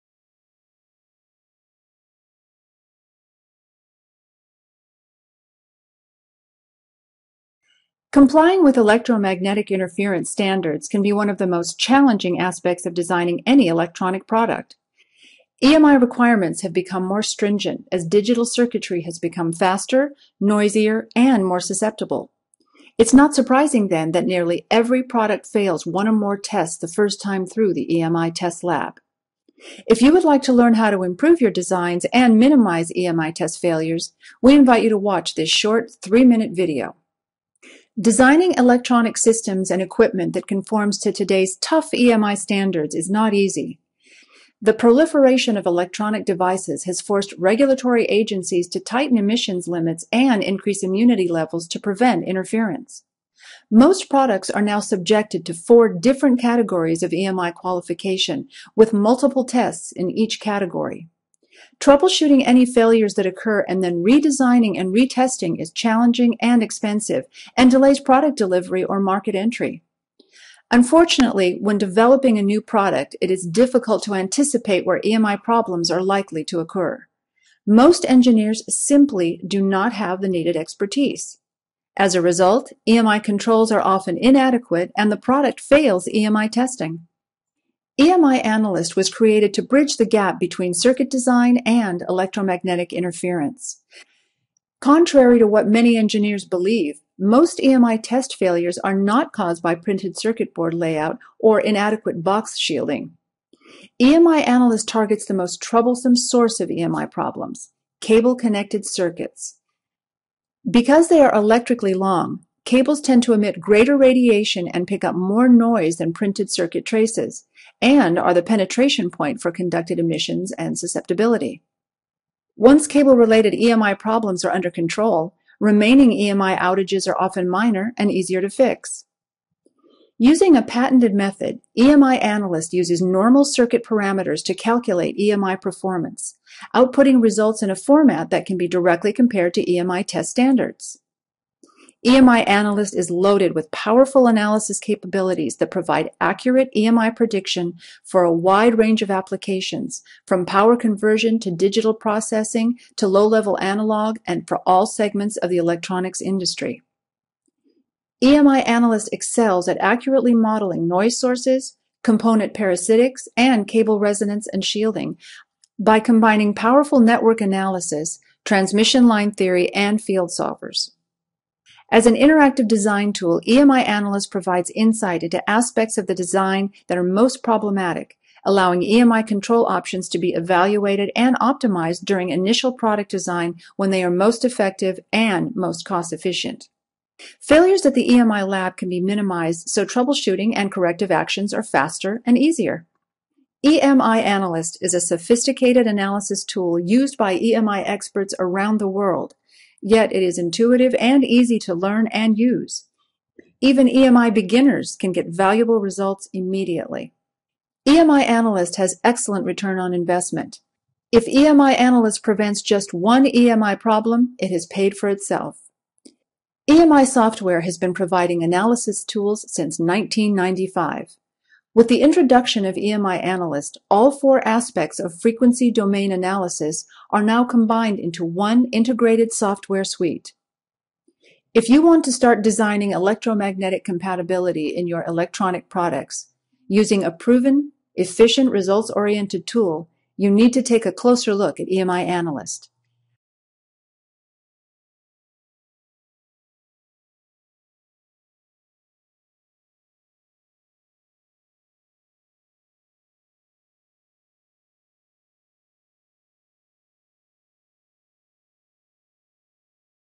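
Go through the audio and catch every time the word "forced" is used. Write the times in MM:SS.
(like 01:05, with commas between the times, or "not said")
00:46.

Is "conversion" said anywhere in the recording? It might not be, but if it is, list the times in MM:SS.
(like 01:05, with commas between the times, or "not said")
02:30.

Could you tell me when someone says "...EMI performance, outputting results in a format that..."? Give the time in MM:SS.
02:15.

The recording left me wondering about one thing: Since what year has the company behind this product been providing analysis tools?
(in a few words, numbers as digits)
1995.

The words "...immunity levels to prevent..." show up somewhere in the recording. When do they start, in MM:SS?
00:50.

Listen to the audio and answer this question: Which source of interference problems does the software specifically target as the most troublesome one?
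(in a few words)
cable connected circuits.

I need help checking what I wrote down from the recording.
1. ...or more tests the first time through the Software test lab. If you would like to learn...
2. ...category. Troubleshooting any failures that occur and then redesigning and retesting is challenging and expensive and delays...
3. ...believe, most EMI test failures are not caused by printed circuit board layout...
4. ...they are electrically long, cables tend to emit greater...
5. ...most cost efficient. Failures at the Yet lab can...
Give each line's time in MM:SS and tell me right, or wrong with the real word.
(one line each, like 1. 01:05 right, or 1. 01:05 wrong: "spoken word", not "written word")
1. 00:26 wrong: "EMI", not "Software"
2. 01:00 right
3. 01:36 right
4. 01:51 right
5. 03:05 wrong: "EMI", not "Yet".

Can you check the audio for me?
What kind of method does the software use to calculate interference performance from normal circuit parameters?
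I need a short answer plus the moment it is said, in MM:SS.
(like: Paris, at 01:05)
patented method, at 02:10.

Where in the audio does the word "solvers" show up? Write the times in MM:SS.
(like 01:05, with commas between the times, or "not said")
02:50.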